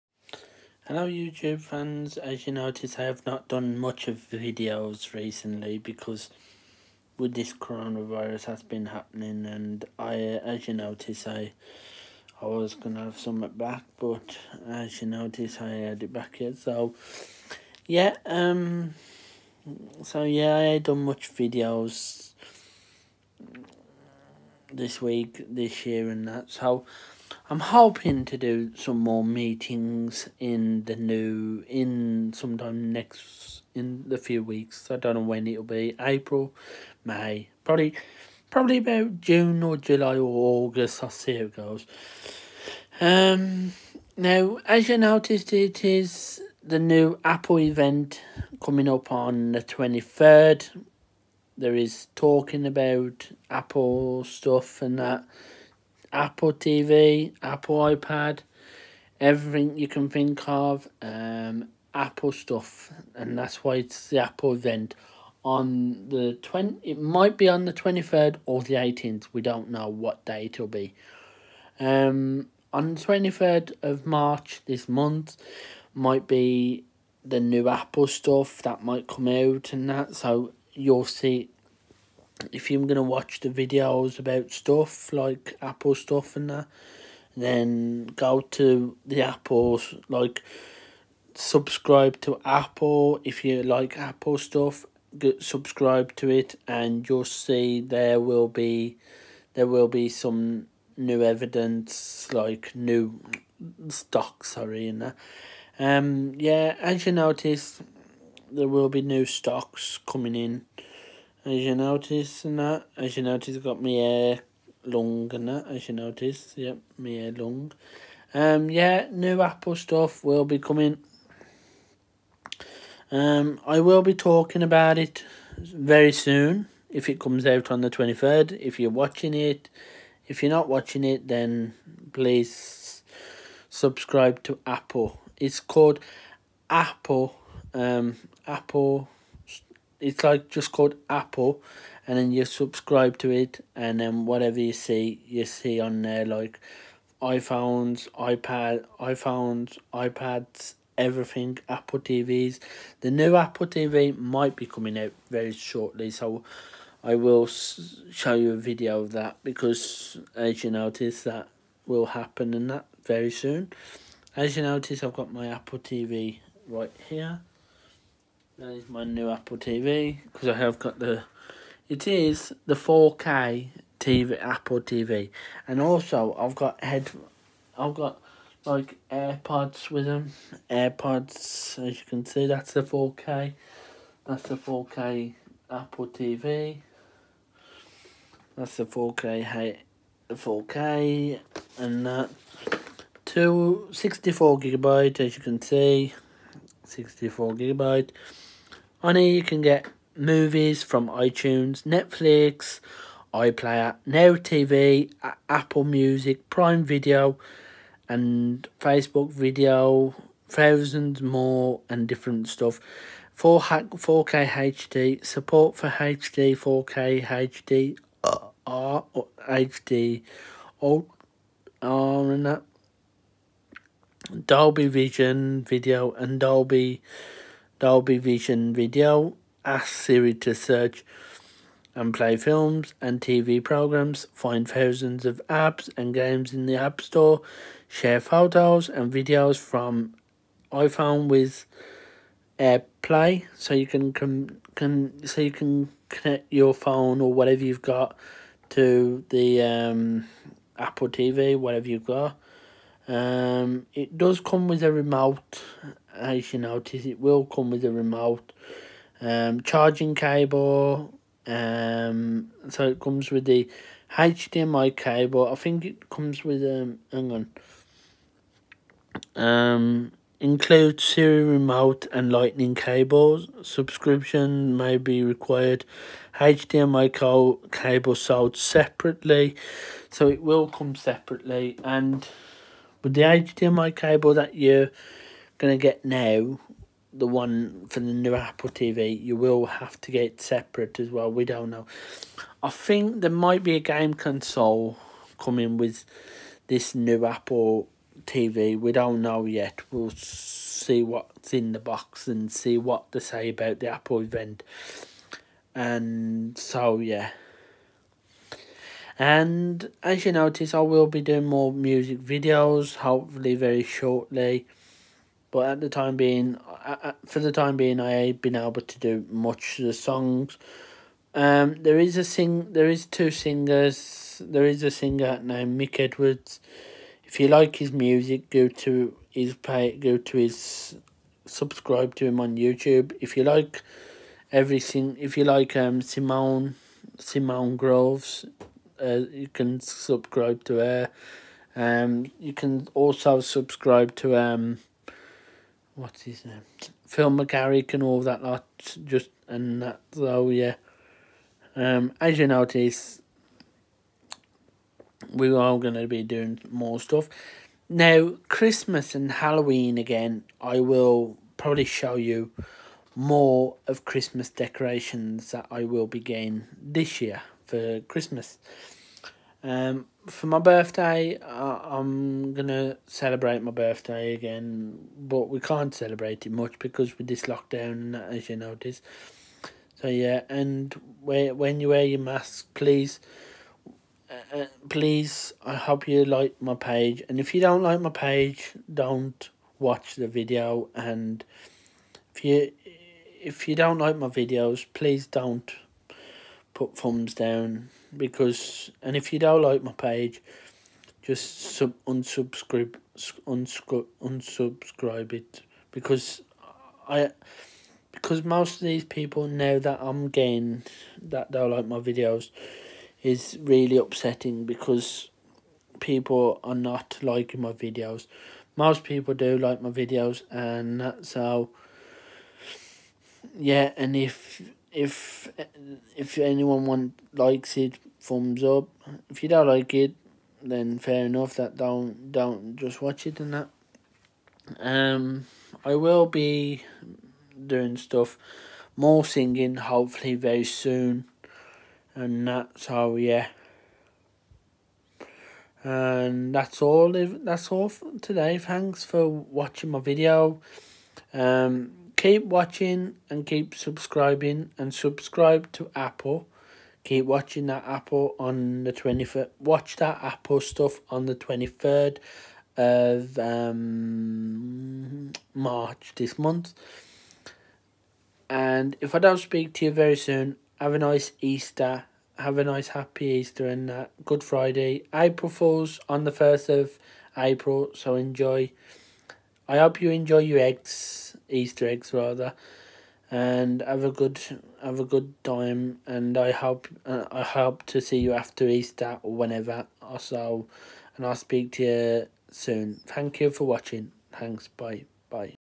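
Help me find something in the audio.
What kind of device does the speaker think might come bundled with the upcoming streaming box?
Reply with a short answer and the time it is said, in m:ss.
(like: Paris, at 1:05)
game console, at 4:53.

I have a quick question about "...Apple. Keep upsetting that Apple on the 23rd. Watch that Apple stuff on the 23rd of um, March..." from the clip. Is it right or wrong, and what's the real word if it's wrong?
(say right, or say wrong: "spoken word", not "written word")
wrong: "watching", not "upsetting".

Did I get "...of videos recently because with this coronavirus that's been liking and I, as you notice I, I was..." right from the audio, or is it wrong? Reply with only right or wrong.
wrong.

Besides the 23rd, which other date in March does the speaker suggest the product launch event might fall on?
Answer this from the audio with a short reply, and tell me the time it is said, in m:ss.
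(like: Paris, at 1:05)
18th, at 1:08.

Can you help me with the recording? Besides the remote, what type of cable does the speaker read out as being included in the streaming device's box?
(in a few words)
Lightning cables.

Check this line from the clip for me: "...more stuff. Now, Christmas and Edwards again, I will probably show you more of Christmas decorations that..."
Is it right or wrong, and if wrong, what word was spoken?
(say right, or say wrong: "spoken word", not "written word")
wrong: "Halloween", not "Edwards".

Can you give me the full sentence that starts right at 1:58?
Um, yeah, new Apple stuff will be coming.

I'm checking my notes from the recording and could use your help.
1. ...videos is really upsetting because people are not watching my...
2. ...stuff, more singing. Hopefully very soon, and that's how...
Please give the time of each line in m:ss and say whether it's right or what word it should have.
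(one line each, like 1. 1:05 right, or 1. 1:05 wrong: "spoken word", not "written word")
1. 6:51 wrong: "liking", not "watching"
2. 7:17 right.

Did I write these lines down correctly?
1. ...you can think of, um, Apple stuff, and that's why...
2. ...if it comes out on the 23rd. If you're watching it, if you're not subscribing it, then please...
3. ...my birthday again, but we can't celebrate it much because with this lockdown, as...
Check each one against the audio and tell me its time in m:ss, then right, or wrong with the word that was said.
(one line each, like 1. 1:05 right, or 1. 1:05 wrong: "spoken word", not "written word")
1. 0:59 right
2. 2:06 wrong: "watching", not "subscribing"
3. 6:13 right.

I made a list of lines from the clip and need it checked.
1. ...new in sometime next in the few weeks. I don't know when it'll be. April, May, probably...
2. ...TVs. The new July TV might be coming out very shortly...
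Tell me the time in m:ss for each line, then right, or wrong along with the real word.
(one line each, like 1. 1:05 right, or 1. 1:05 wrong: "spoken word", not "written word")
1. 0:30 right
2. 2:31 wrong: "Apple", not "July".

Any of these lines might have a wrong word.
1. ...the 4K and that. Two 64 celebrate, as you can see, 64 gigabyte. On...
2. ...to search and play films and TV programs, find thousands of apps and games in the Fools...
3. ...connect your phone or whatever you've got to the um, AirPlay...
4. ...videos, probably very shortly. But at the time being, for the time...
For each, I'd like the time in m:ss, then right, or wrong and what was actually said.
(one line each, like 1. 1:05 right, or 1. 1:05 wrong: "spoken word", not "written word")
1. 3:10 wrong: "gigabyte", not "celebrate"
2. 3:50 wrong: "App", not "Fools"
3. 4:06 wrong: "Apple", not "AirPlay"
4. 5:12 wrong: "hopefully", not "probably".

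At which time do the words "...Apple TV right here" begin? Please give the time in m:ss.
2:45.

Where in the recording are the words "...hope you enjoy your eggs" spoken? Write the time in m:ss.
7:59.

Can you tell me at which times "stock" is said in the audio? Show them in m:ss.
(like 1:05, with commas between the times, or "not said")
1:43, 1:49.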